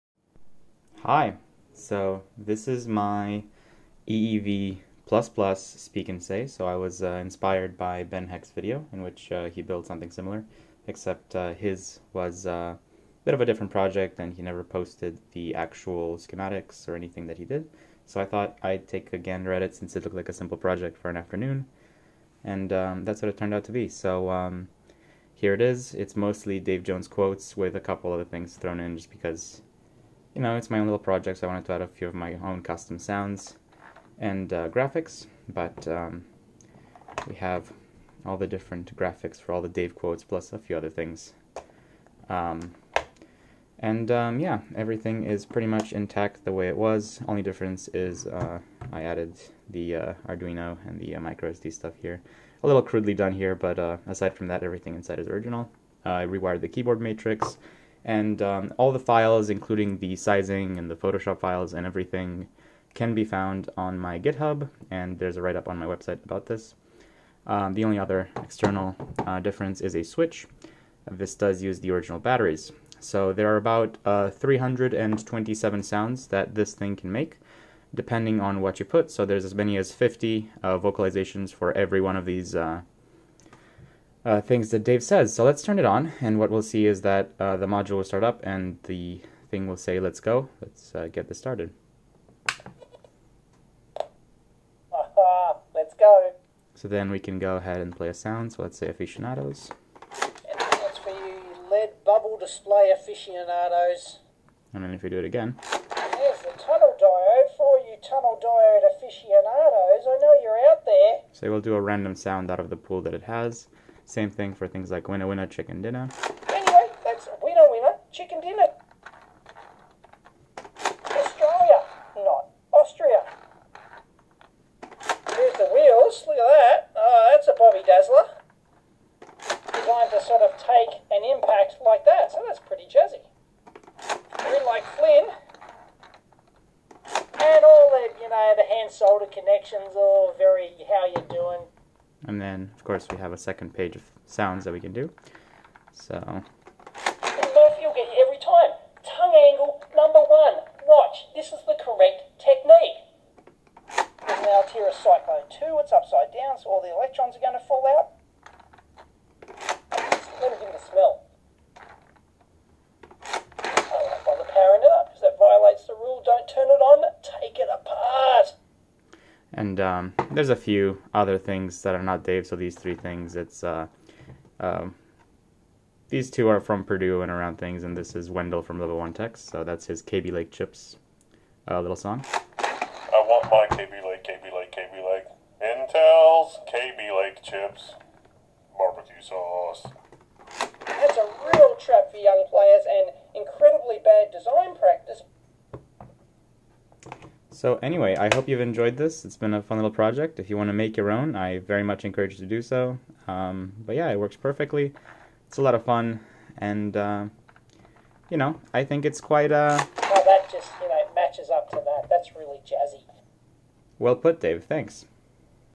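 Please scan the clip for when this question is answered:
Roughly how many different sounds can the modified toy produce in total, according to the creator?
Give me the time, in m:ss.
1:14.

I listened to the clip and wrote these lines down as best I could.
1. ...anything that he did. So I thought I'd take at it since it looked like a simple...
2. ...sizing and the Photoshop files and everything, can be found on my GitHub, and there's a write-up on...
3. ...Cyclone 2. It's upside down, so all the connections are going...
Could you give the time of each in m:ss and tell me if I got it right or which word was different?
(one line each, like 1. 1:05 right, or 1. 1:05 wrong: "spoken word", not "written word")
1. 0:16 right
2. 1:00 right
3. 2:34 wrong: "electrons", not "connections".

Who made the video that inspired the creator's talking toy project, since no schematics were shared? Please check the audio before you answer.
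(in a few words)
Ben Heck.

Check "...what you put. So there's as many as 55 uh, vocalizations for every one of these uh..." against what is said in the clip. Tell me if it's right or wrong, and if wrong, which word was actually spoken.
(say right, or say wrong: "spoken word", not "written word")
wrong: "50", not "55".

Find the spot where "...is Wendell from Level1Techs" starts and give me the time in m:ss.
2:58.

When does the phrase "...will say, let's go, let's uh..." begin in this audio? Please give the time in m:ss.
1:29.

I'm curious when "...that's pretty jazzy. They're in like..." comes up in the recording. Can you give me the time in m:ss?
2:12.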